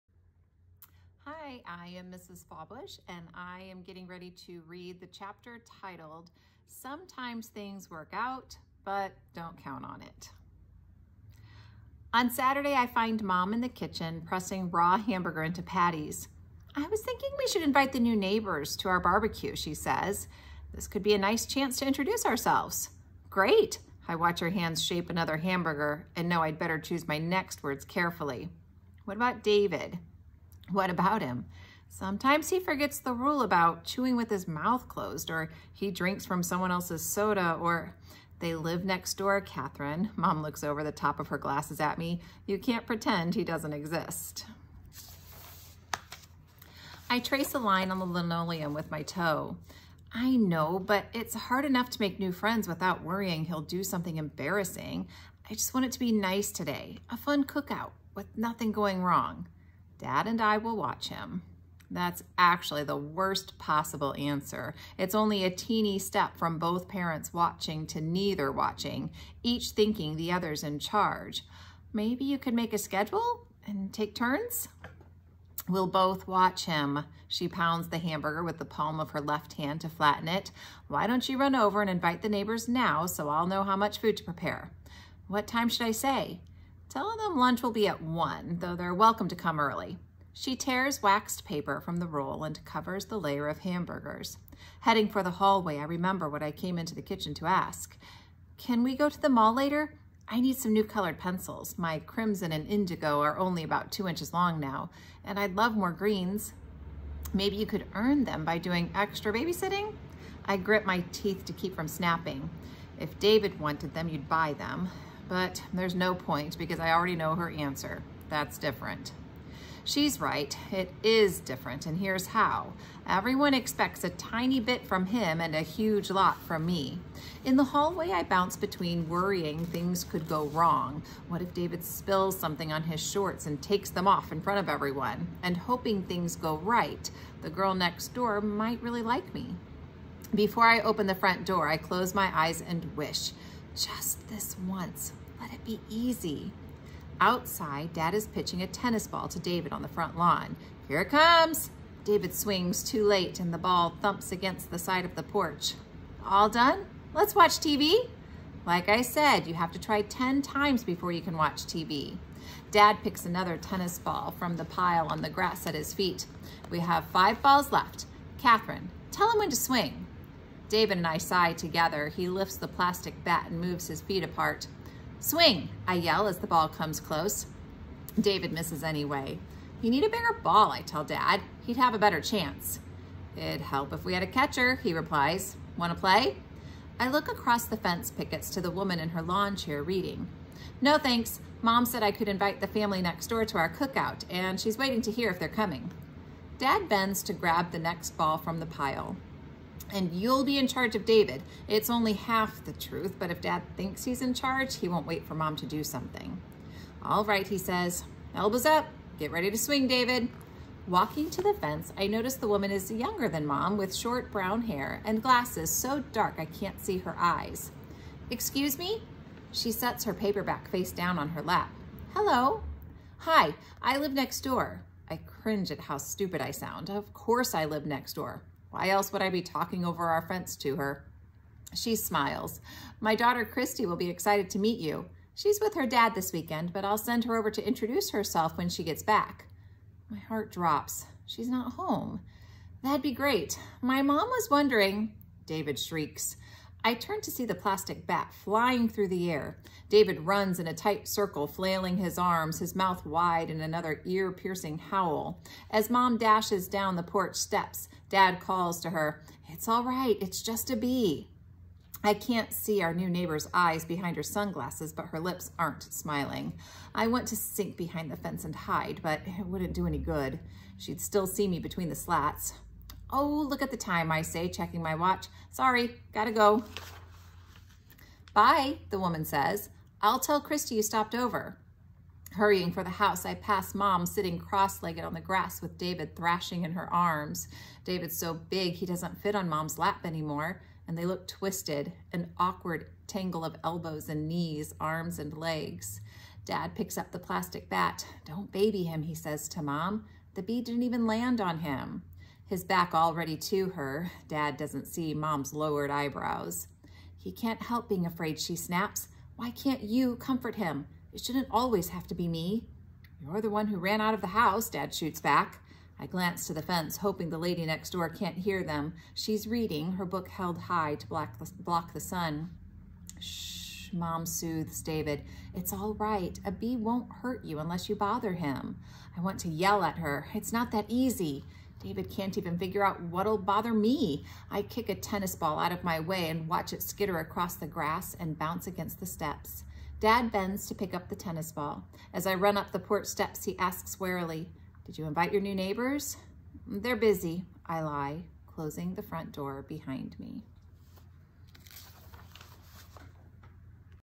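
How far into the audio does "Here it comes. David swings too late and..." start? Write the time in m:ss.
2:30.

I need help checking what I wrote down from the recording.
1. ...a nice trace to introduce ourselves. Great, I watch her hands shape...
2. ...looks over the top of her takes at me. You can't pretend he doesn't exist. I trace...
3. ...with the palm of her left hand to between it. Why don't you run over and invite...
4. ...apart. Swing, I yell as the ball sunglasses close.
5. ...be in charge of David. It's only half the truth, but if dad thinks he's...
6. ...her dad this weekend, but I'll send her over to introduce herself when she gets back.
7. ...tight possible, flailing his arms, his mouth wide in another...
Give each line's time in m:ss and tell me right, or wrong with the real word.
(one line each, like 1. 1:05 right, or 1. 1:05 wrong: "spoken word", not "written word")
1. 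0:21 wrong: "chance", not "trace"
2. 0:40 wrong: "glasses", not "takes"
3. 1:18 wrong: "flatten", not "between"
4. 2:54 wrong: "comes", not "sunglasses"
5. 3:20 right
6. 3:55 right
7. 4:10 wrong: "circle", not "possible".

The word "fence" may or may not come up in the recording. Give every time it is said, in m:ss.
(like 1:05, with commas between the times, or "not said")
3:07, 3:31, 3:50, 4:28, 5:16.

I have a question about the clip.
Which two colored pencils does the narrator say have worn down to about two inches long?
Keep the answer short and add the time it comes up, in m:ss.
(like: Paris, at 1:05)
crimson and indigo, at 1:41.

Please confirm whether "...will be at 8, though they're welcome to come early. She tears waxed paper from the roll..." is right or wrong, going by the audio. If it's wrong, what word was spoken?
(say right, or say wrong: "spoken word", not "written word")
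wrong: "1", not "8".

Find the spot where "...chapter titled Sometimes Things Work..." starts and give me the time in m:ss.
0:05.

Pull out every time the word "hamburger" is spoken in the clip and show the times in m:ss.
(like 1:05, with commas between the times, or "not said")
0:14, 0:25, 1:17, 1:33.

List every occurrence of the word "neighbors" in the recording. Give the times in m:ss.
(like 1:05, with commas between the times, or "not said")
0:18, 1:22, 4:23, 5:45.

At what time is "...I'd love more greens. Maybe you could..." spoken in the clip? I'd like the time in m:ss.
1:45.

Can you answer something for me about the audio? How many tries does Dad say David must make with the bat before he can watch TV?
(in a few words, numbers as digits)
10.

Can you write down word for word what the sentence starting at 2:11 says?
What if David spills something on his shorts and takes them off in front of everyone?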